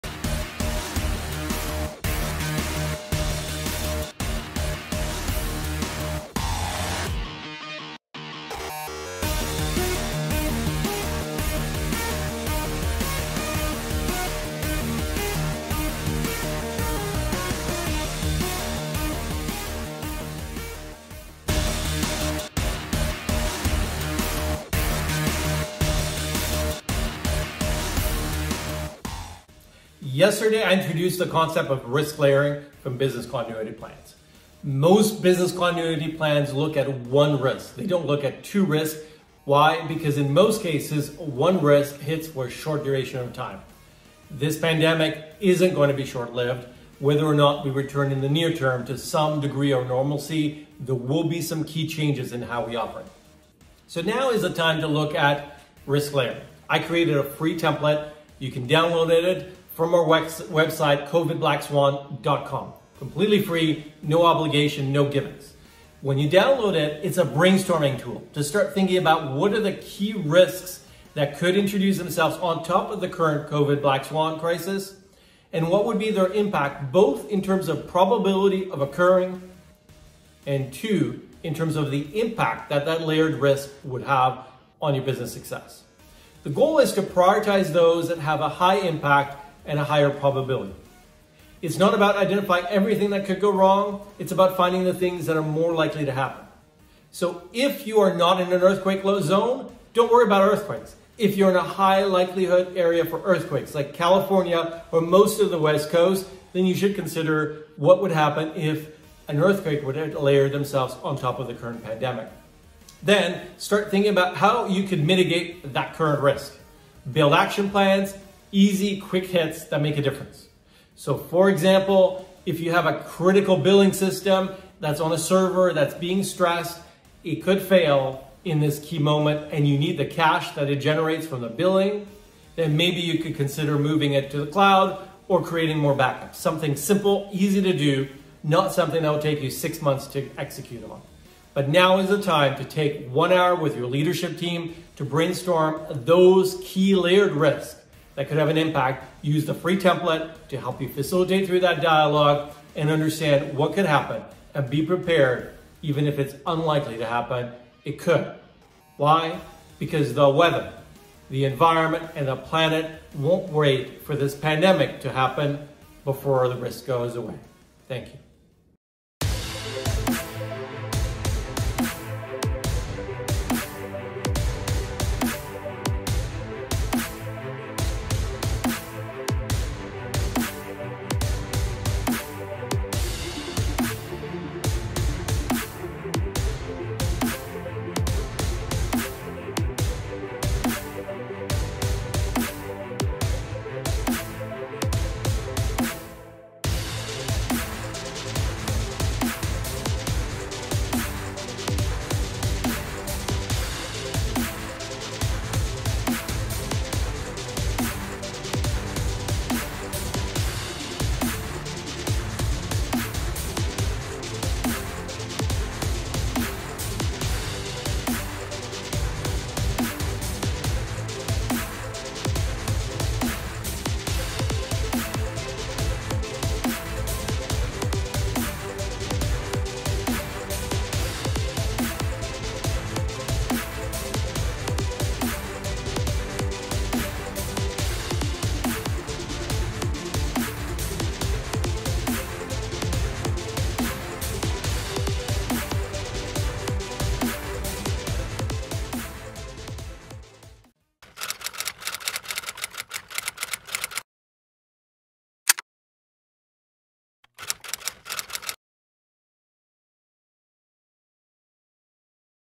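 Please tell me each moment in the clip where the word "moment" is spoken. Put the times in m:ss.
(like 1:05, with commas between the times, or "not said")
2:08.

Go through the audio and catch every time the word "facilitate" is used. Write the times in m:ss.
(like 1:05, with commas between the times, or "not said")
2:30.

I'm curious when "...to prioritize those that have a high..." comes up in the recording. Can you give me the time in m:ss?
1:26.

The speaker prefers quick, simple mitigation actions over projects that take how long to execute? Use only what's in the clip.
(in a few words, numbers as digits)
6 months.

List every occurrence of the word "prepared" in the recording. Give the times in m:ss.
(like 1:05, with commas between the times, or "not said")
2:34.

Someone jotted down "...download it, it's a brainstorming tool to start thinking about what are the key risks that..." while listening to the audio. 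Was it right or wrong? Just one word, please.
right.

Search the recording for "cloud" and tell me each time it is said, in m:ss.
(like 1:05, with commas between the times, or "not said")
2:14.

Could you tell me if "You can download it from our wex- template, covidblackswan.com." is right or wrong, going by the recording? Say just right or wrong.
wrong.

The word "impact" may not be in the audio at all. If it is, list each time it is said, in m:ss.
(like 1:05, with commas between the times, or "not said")
1:16, 1:22, 1:28, 2:28.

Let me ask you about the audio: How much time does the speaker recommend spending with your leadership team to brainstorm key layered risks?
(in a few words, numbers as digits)
1 hour.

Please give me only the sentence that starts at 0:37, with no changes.
They don't look at two risks.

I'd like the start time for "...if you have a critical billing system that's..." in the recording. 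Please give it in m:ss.
2:02.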